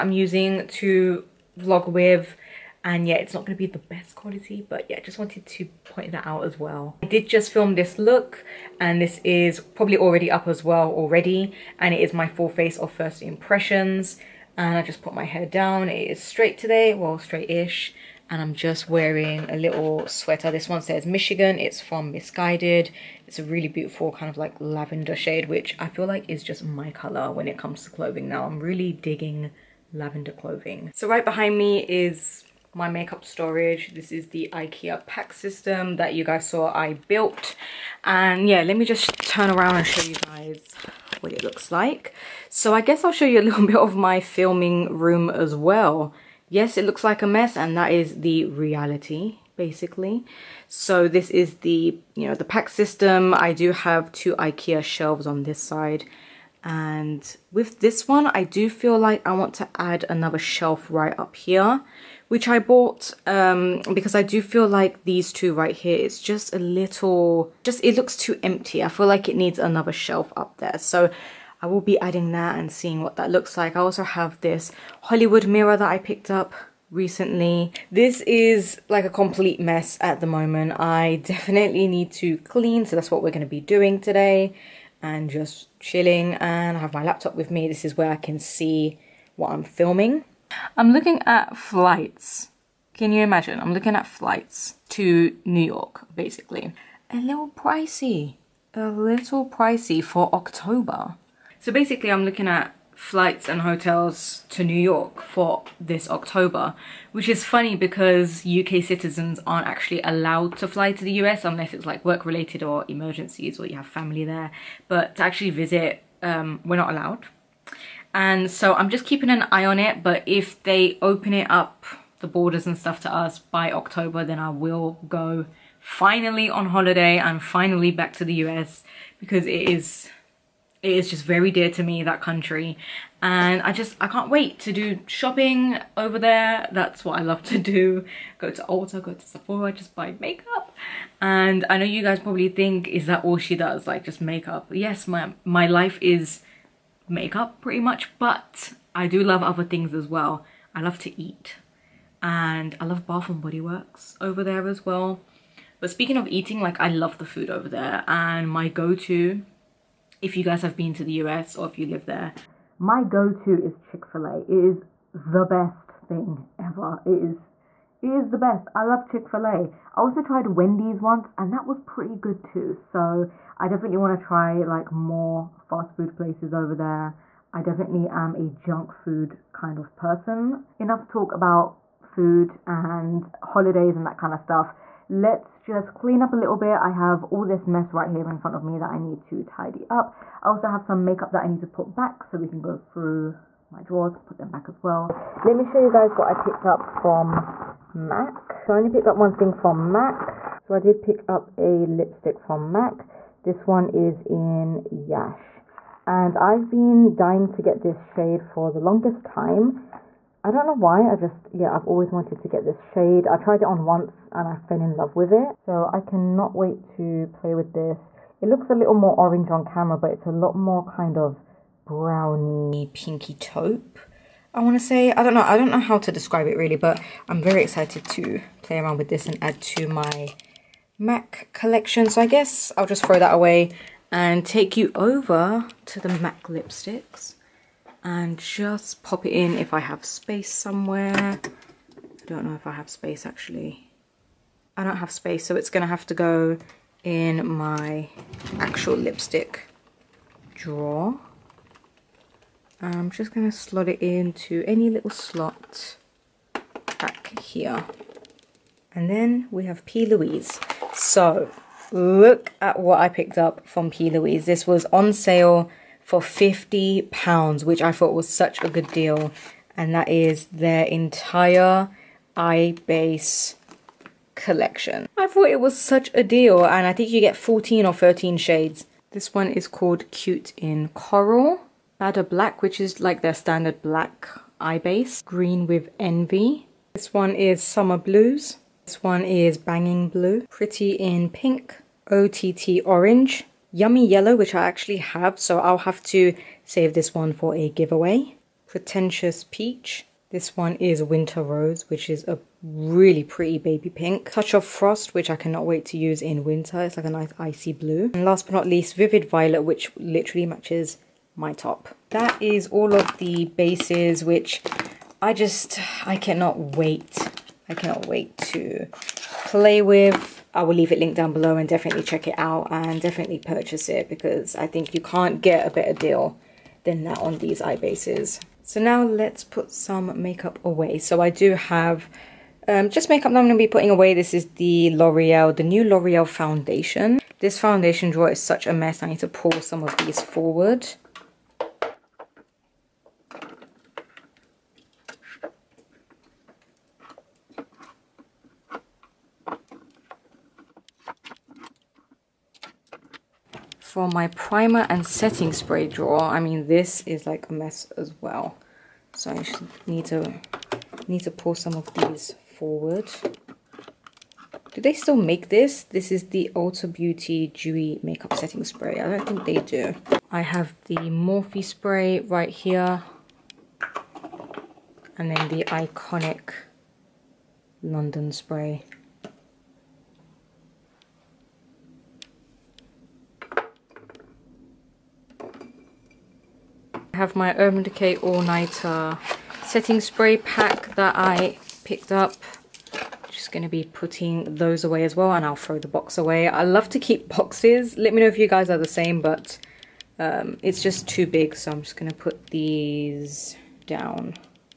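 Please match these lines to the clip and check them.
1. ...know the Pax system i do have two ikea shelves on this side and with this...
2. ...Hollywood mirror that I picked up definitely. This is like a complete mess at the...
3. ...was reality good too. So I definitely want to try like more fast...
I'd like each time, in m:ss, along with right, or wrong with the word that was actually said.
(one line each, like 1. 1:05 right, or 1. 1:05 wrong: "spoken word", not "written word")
1. 0:52 right
2. 1:15 wrong: "recently", not "definitely"
3. 2:51 wrong: "pretty", not "reality".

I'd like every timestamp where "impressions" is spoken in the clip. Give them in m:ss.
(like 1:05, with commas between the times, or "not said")
0:13.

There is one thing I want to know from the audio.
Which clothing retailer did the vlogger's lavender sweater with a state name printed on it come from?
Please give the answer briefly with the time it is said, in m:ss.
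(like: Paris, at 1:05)
Missguided, at 0:22.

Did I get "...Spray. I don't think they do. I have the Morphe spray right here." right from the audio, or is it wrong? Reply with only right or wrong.
right.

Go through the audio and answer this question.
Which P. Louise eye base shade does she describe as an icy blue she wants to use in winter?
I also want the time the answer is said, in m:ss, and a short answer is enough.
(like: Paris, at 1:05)
Touch of Frost, at 5:04.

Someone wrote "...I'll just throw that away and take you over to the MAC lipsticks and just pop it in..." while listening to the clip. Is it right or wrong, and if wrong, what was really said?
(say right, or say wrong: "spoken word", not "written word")
right.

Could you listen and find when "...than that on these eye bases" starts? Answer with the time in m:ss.
5:26.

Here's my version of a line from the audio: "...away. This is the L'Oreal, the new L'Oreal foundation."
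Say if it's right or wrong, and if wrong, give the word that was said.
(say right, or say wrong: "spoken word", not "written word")
right.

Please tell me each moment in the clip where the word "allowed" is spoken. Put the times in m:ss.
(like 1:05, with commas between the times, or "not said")
1:50, 1:56.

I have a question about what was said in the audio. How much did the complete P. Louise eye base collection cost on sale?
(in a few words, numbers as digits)
£50.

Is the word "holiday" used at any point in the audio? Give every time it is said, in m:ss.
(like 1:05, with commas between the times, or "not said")
2:06, 3:03.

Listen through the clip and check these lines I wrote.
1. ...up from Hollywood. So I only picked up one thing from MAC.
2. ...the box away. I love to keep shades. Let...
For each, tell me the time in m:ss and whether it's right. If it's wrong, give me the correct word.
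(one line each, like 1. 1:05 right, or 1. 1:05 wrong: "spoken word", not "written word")
1. 3:16 wrong: "MAC", not "Hollywood"
2. 6:35 wrong: "boxes", not "shades".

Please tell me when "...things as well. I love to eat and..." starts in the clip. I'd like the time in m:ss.
2:29.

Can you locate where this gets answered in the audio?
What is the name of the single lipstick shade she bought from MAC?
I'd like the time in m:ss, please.
3:24.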